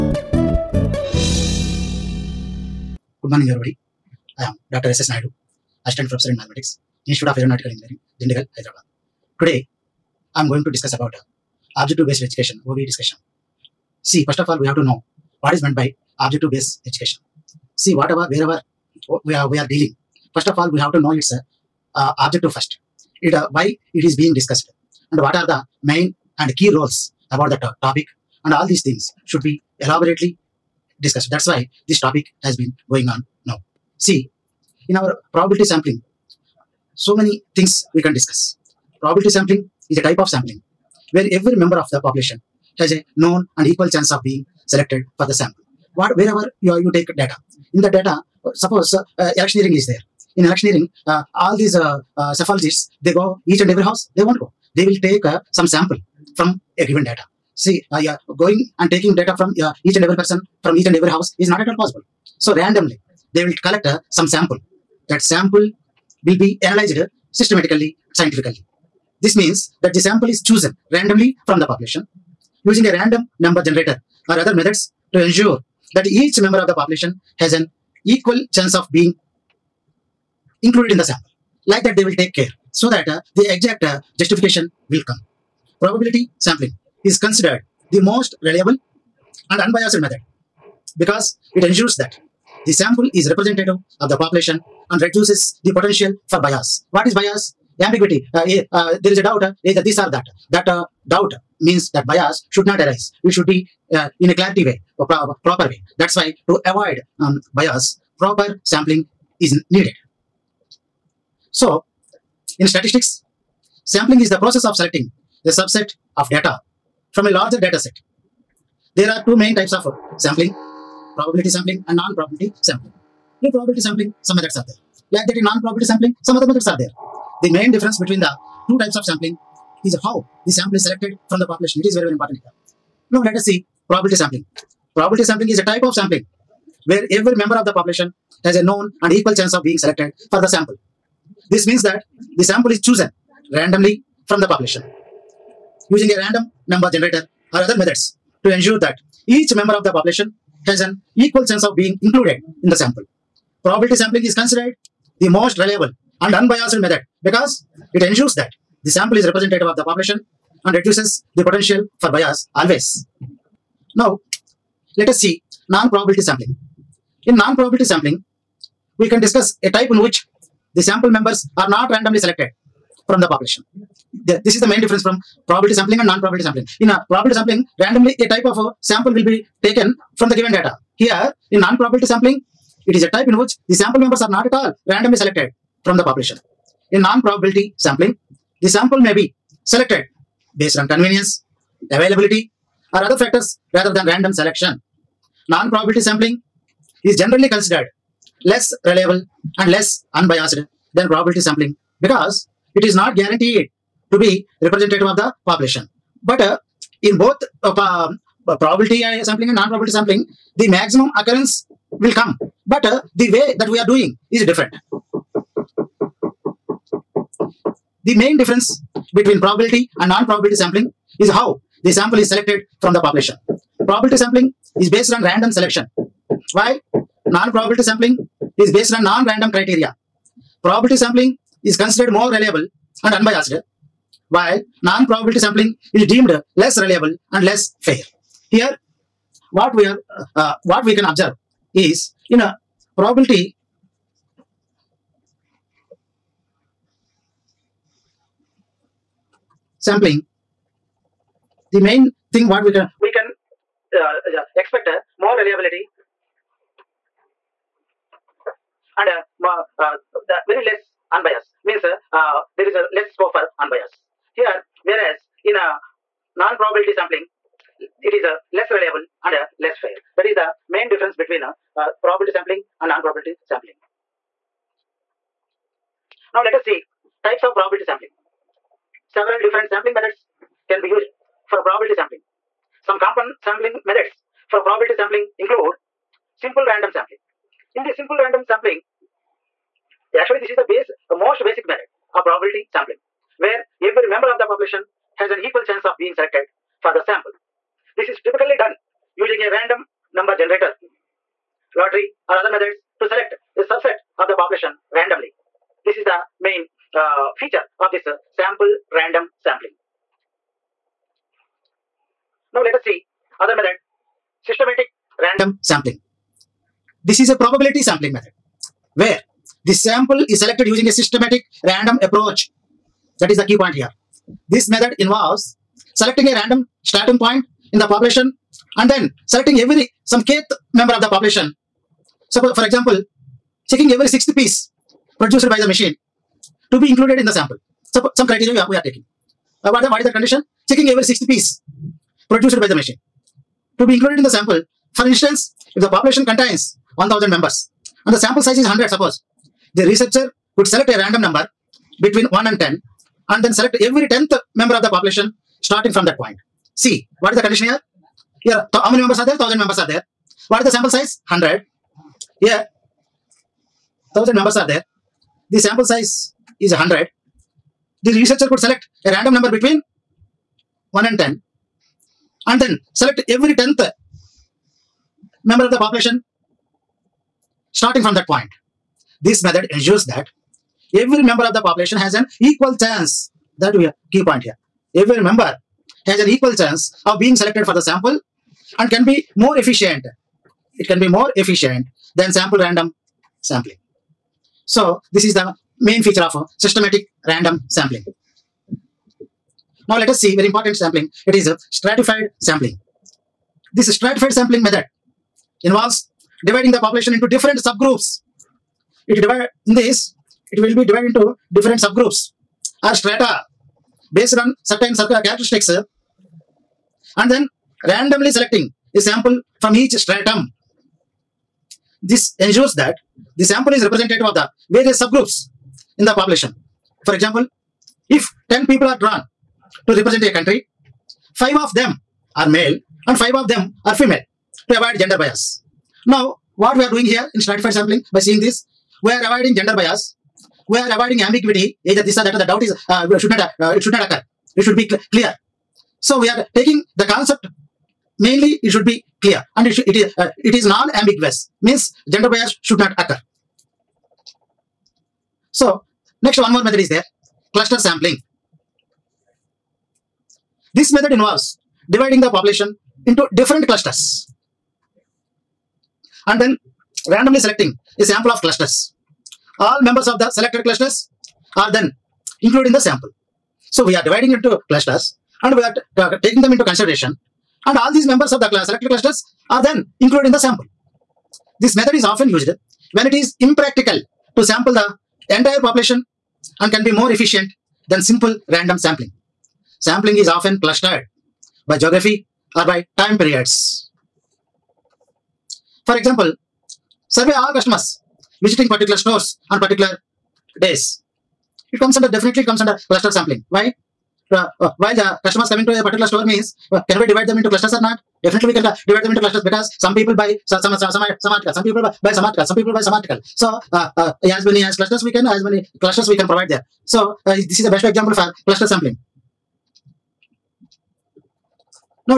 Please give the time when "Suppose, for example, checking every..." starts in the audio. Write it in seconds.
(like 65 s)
332 s.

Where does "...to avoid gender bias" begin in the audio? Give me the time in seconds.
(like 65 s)
434 s.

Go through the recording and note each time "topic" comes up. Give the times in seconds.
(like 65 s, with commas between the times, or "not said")
27 s, 31 s.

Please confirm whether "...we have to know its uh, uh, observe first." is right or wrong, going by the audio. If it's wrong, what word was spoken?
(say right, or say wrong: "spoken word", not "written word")
wrong: "objective", not "observe".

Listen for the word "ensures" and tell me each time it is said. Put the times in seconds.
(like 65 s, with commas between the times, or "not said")
75 s, 91 s, 148 s, 158 s, 379 s, 422 s.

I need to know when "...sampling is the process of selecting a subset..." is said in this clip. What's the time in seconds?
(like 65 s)
113 s.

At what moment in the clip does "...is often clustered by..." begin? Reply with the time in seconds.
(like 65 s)
490 s.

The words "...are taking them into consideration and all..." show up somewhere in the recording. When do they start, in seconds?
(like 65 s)
475 s.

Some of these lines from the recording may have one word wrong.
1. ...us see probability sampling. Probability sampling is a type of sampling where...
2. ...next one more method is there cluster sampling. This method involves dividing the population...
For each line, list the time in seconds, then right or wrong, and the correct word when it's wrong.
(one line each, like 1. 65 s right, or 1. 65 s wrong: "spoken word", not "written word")
1. 133 s right
2. 456 s right.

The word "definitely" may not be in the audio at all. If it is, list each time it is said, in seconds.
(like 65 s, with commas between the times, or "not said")
502 s, 508 s.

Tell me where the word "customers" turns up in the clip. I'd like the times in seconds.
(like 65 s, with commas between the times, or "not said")
497 s, 505 s.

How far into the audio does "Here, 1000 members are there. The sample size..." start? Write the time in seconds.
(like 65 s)
362 s.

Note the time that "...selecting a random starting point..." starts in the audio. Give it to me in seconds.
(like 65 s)
325 s.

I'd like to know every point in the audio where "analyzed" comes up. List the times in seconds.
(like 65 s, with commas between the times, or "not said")
66 s.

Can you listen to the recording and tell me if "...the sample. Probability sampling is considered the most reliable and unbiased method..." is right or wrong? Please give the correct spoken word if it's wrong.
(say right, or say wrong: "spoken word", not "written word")
right.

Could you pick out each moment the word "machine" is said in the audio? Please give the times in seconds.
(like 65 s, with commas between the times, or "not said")
335 s, 342 s.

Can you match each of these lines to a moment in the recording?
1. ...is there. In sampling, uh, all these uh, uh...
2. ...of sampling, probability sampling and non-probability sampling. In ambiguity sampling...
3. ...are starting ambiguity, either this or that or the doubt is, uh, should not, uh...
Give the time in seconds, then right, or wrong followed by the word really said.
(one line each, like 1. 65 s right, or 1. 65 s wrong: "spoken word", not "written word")
1. 49 s wrong: "electioneering", not "sampling"
2. 119 s wrong: "probability", not "ambiguity"
3. 440 s wrong: "avoiding", not "starting".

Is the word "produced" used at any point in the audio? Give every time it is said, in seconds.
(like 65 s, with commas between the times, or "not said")
335 s, 342 s.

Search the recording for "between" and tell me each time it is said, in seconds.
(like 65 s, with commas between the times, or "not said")
127 s, 219 s, 271 s, 352 s, 369 s.